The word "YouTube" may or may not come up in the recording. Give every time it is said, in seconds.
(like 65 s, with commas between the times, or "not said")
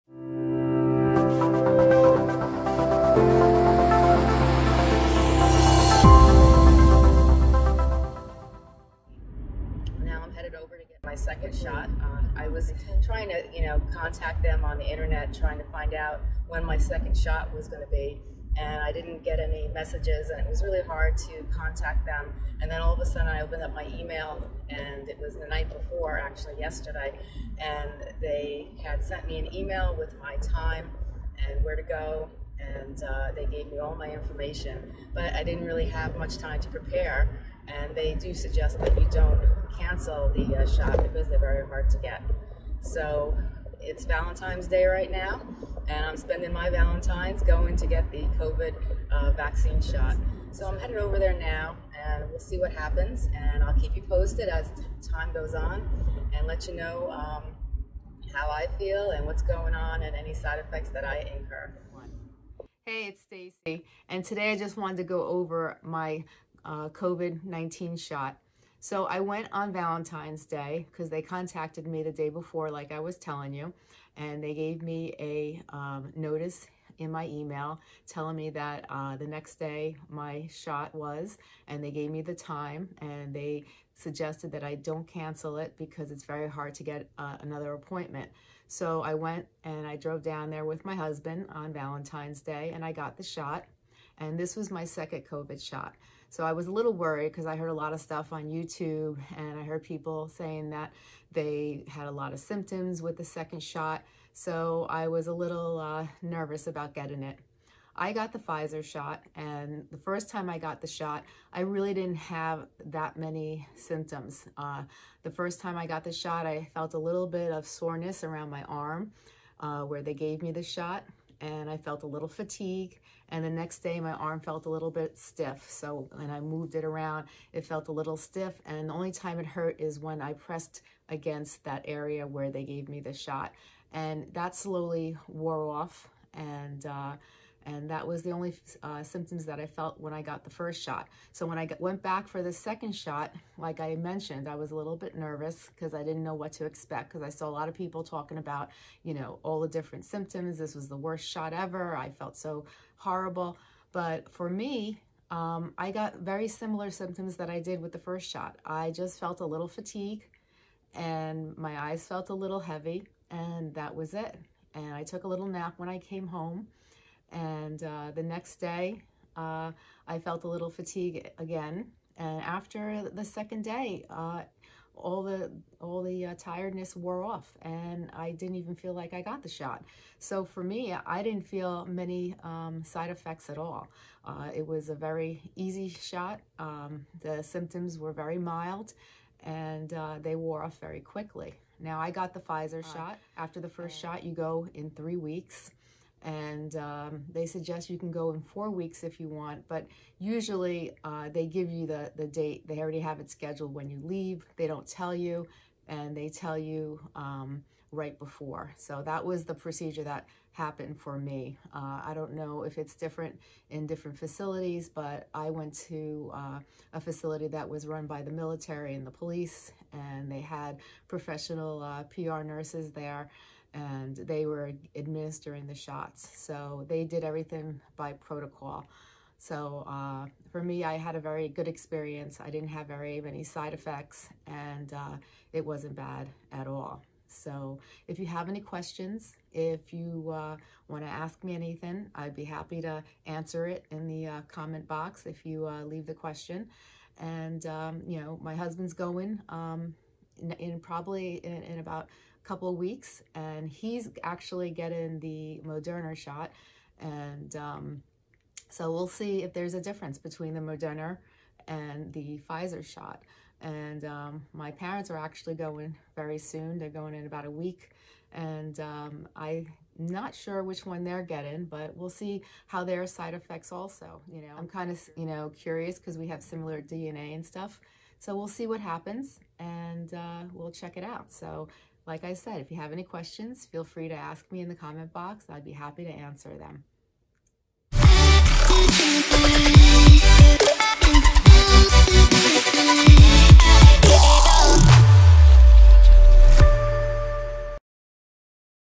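98 s.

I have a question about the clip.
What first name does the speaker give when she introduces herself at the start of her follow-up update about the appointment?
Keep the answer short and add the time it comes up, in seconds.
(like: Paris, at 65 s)
Stacey, at 63 s.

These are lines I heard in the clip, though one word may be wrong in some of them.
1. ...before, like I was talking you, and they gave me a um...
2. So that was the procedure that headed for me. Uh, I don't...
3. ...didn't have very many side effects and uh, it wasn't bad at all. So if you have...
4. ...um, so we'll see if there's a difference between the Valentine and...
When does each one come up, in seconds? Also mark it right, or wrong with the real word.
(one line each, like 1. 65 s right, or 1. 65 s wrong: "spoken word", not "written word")
1. 72 s wrong: "telling", not "talking"
2. 208 s wrong: "happened", not "headed"
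3. 232 s right
4. 257 s wrong: "Moderna", not "Valentine".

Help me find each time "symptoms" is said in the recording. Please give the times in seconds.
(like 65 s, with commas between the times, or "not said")
102 s, 113 s, 139 s, 150 s, 156 s, 187 s.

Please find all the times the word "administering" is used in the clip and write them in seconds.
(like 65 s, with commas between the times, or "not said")
224 s.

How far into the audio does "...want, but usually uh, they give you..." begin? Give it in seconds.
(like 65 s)
199 s.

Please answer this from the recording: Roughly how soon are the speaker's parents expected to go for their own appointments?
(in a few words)
About 1 week.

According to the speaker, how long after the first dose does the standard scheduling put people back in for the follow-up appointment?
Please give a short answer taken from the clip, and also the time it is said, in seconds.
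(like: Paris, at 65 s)
3 weeks, at 194 s.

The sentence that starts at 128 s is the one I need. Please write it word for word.
And the only time it hurt is when I pressed against that area where they gave me the shot.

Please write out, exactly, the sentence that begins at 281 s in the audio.
So like I said, if you have any questions, feel free to ask me in the comment box.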